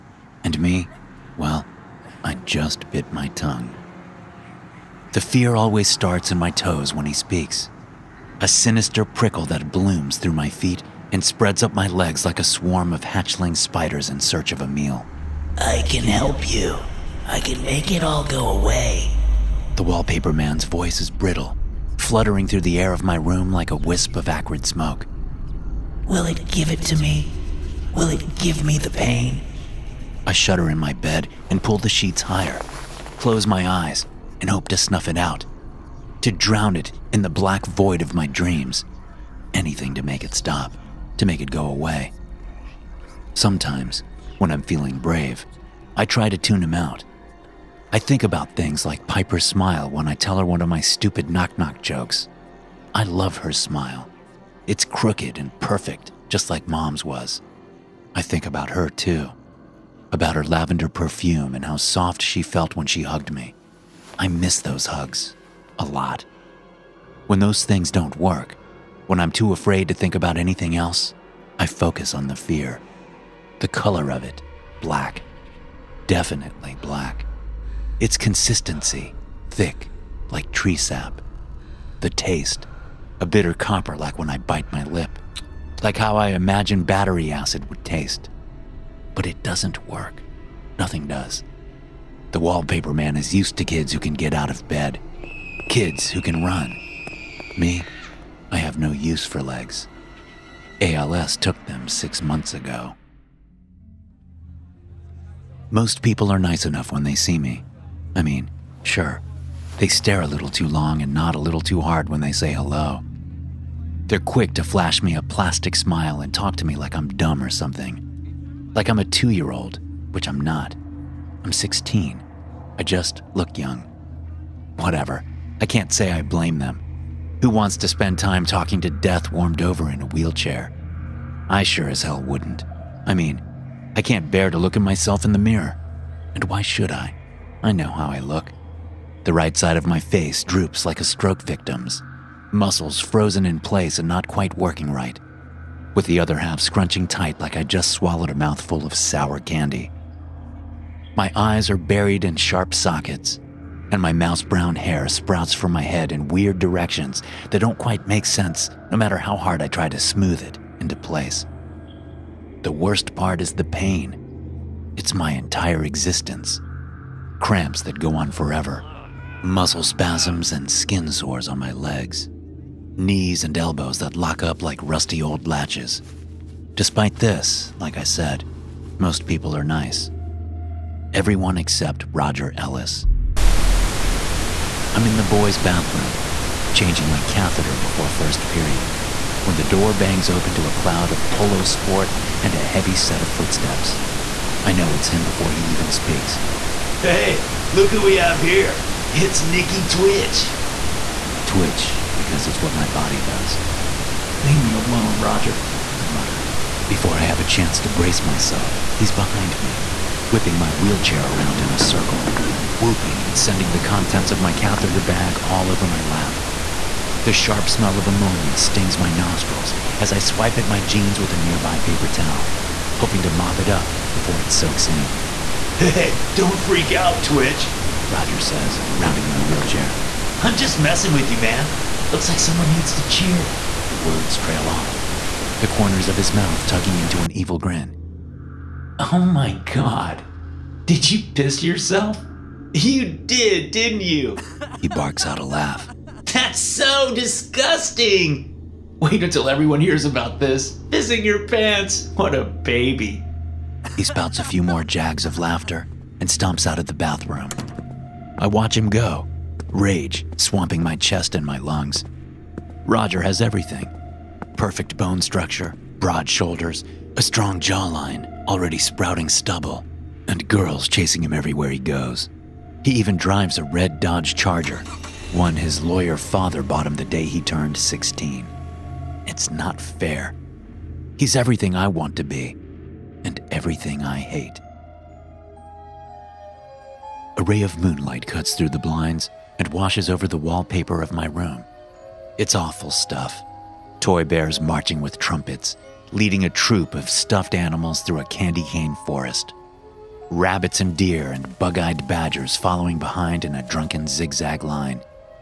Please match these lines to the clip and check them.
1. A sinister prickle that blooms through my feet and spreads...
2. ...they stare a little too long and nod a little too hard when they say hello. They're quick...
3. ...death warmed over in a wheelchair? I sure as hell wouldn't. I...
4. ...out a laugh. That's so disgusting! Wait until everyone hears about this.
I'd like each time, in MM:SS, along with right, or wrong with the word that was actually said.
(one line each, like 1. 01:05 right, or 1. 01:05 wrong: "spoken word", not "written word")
1. 00:08 right
2. 01:49 right
3. 02:08 right
4. 04:05 right.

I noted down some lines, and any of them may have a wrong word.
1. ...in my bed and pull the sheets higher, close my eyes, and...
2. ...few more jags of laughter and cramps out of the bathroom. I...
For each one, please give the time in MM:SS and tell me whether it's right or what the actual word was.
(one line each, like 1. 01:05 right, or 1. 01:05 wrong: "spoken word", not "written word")
1. 00:30 right
2. 04:14 wrong: "stomps", not "cramps".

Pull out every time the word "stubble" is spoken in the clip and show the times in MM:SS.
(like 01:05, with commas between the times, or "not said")
04:29.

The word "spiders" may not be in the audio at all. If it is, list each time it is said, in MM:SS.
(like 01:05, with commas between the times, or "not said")
00:13.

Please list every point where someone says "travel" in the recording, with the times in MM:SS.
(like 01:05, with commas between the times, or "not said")
not said.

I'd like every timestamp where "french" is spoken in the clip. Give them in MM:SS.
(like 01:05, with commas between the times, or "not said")
not said.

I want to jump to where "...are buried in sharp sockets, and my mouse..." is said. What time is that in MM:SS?
02:31.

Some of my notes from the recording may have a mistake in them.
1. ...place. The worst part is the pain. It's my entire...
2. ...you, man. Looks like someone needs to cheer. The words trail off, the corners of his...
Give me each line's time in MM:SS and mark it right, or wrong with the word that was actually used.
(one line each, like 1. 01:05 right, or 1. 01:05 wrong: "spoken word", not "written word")
1. 02:40 right
2. 03:51 right.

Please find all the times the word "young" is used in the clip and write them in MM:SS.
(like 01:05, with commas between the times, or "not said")
02:03.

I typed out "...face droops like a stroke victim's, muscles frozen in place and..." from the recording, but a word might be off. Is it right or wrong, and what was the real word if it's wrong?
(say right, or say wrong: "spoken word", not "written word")
right.